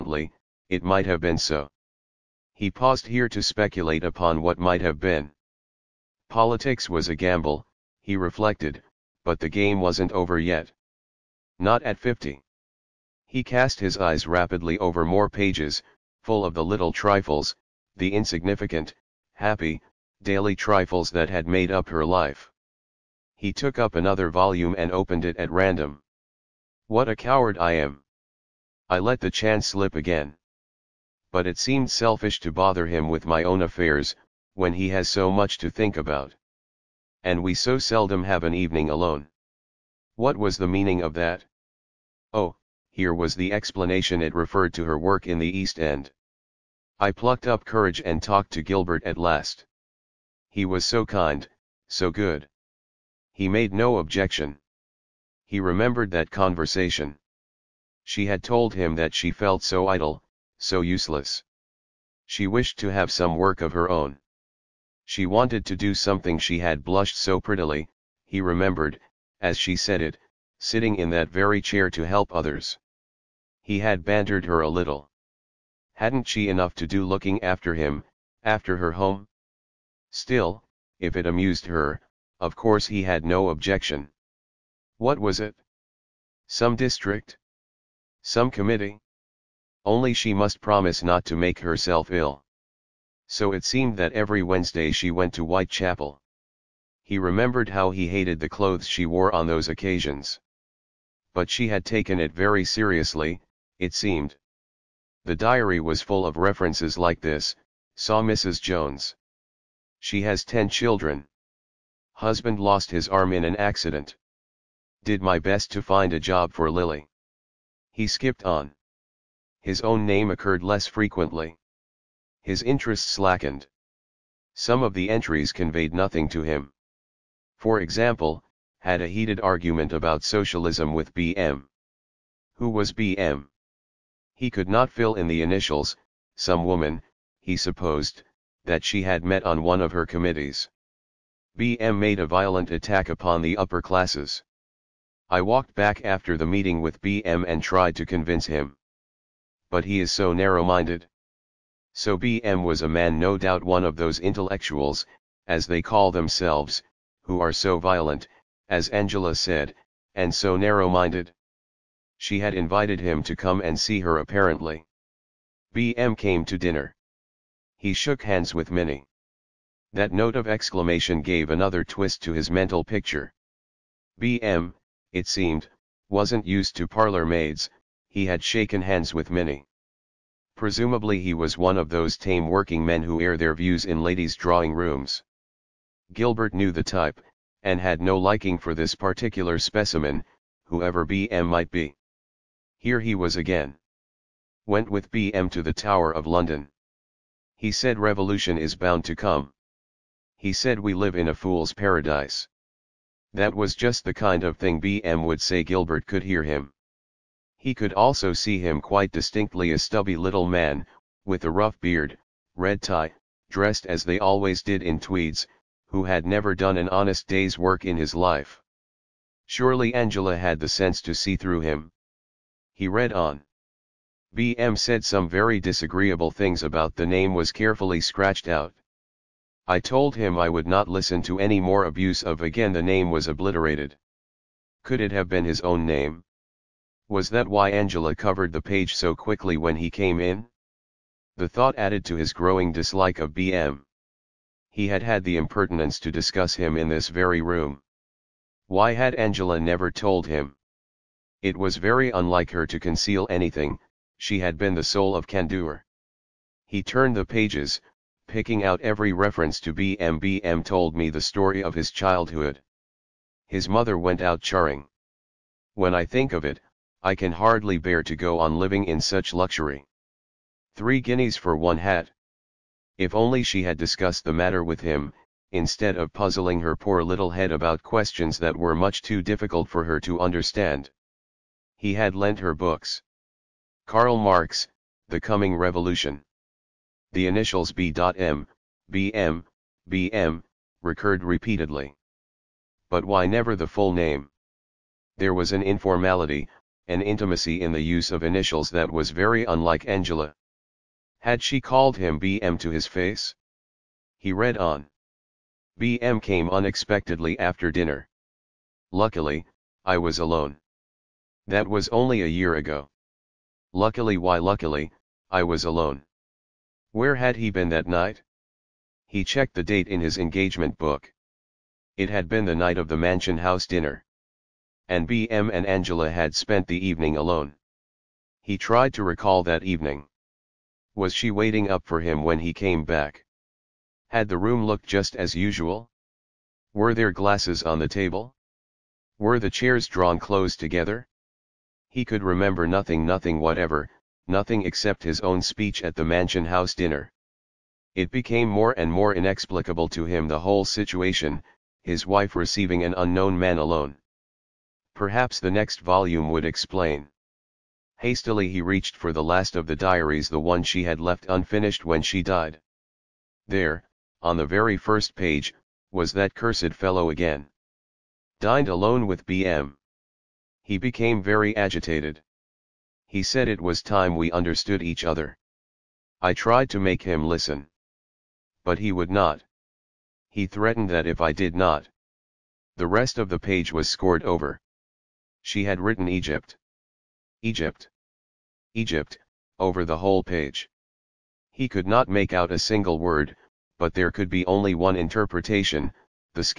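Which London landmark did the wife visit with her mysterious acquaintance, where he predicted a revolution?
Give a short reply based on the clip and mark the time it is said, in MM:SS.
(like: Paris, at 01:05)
The Tower of London, at 03:15.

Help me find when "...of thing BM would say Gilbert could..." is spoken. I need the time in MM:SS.
03:24.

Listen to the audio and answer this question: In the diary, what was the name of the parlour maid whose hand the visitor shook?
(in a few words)
Minnie.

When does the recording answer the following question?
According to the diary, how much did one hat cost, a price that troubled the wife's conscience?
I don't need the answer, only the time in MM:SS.
04:30.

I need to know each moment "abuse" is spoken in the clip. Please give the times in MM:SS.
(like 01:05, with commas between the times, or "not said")
03:51.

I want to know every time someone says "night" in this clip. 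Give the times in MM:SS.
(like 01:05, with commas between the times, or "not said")
05:17, 05:22.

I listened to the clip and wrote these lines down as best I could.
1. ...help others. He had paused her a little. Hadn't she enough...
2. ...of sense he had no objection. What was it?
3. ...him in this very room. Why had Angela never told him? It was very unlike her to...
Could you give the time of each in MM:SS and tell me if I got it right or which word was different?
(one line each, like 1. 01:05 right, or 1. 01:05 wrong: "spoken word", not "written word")
1. 01:12 wrong: "bantered", not "paused"
2. 01:22 wrong: "course", not "sense"
3. 04:06 right.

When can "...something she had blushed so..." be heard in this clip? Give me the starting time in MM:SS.
01:05.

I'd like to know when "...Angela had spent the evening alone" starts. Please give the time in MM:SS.
05:25.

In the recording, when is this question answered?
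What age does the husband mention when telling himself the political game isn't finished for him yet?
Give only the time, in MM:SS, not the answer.
00:11.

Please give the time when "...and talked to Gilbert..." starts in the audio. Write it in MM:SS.
00:48.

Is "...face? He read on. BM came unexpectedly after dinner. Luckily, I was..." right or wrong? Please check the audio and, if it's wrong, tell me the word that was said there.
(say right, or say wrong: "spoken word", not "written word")
right.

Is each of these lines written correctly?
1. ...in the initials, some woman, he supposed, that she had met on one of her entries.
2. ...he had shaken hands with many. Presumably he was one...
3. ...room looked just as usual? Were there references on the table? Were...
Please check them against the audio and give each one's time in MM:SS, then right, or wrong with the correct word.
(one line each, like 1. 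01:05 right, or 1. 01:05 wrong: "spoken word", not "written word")
1. 02:15 wrong: "committees", not "entries"
2. 02:58 right
3. 05:34 wrong: "glasses", not "references".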